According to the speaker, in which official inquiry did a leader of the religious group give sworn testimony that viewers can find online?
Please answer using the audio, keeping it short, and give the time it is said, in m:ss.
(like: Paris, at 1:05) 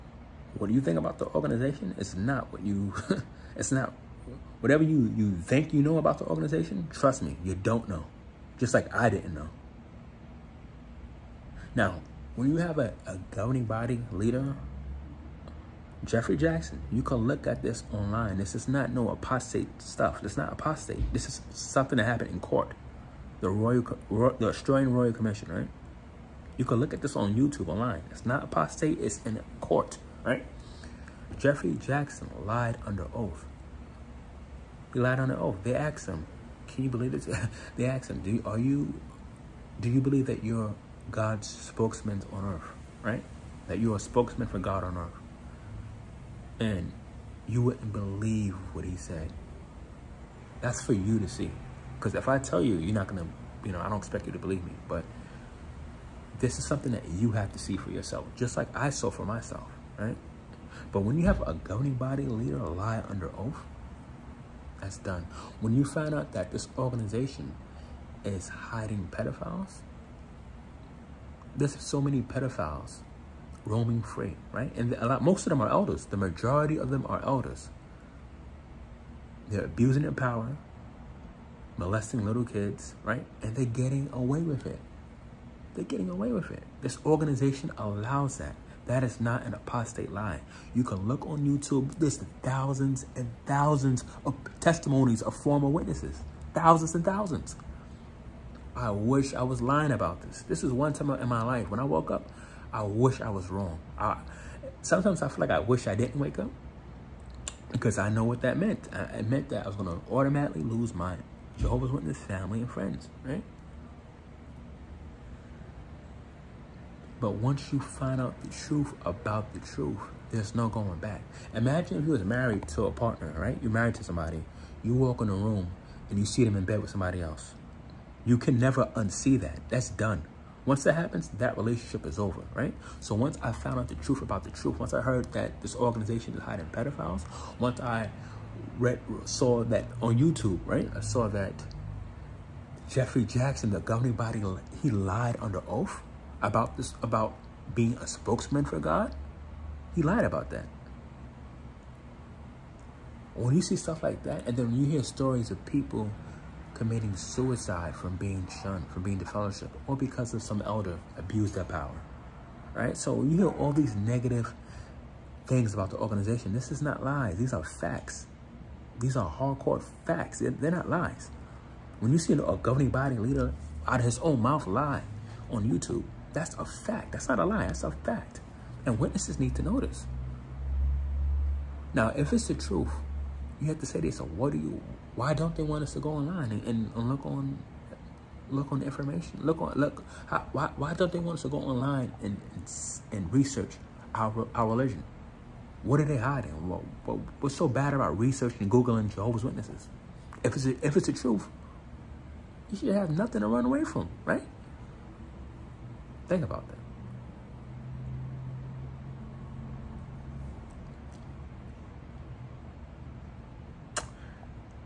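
Australian Royal Commission, at 0:24.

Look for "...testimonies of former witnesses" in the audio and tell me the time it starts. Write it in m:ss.
1:34.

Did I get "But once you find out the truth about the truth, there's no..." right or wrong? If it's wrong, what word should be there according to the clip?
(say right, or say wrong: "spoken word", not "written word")
right.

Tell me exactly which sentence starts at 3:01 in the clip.
Now, if it's the truth, you have to say this.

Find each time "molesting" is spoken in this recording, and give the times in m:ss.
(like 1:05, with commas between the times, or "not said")
1:21.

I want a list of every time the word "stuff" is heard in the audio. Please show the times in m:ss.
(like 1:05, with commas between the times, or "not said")
0:19, 2:33.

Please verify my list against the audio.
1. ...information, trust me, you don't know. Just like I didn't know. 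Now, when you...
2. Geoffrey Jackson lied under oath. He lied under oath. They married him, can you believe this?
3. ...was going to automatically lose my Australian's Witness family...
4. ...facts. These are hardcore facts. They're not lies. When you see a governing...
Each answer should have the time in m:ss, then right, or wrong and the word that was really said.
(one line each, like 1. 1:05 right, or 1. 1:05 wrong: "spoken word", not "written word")
1. 0:06 wrong: "organization", not "information"
2. 0:31 wrong: "asked", not "married"
3. 1:49 wrong: "Jehovah", not "Australian"
4. 2:47 right.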